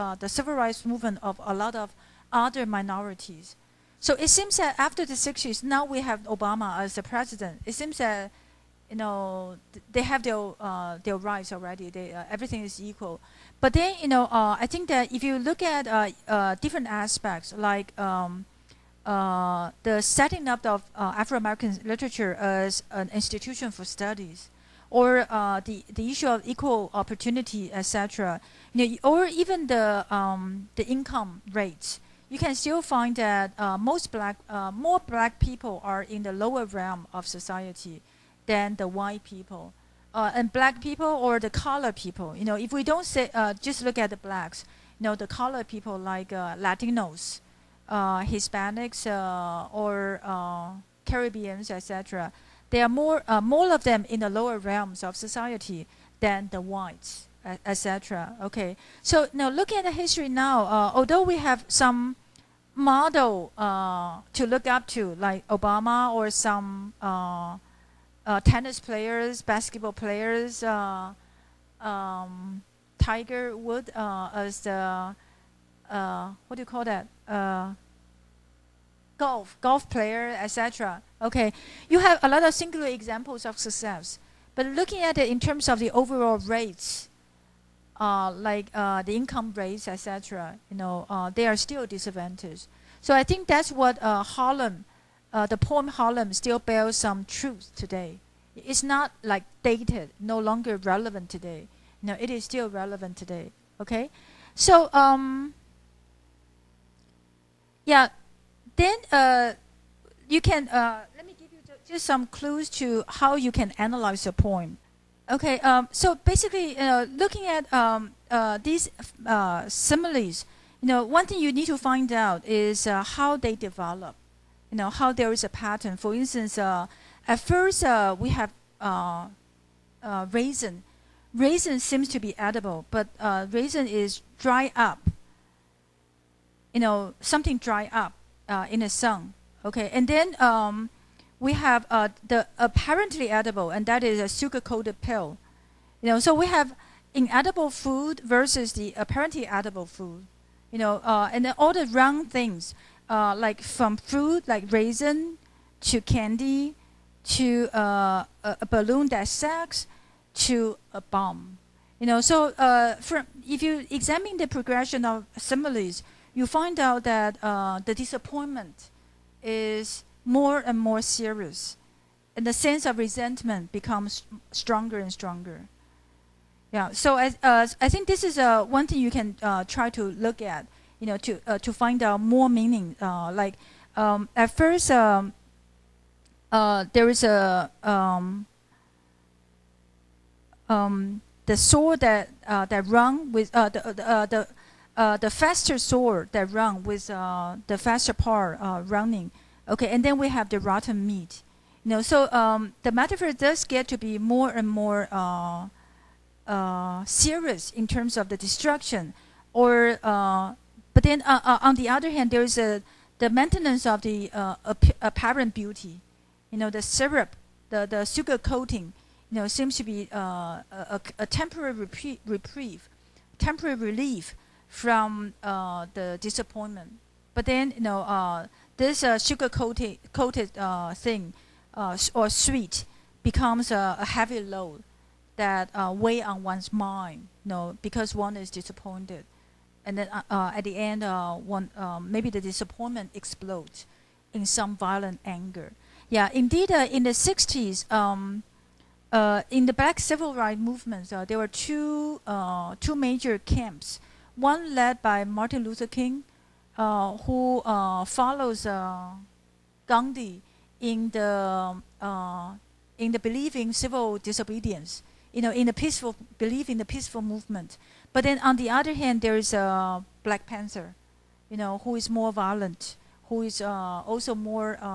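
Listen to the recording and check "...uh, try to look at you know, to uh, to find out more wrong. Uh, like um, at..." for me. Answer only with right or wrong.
wrong.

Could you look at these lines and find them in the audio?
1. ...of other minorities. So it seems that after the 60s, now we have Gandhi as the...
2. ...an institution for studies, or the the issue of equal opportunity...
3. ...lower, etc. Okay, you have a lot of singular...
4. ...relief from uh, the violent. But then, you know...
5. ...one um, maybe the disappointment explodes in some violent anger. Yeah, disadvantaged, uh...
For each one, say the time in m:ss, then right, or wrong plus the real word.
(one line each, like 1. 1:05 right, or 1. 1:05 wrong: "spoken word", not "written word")
1. 0:01 wrong: "Obama", not "Gandhi"
2. 0:22 right
3. 1:19 wrong: "player", not "lower"
4. 3:43 wrong: "disappointment", not "violent"
5. 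4:01 wrong: "indeed", not "disadvantaged".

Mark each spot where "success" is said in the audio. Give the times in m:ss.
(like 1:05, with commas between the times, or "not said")
1:23.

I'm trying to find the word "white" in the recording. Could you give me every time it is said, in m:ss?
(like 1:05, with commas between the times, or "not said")
0:38, 0:56.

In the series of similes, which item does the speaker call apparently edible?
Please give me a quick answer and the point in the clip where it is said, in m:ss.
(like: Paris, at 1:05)
sugar-coated pill, at 2:24.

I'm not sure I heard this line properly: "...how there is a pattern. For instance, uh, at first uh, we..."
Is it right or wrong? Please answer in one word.
right.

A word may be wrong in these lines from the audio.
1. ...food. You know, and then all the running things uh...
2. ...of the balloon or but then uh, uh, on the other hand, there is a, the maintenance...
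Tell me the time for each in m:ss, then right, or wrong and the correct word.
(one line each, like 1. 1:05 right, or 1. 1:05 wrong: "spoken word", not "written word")
1. 2:29 wrong: "wrong", not "running"
2. 3:28 wrong: "destruction", not "balloon".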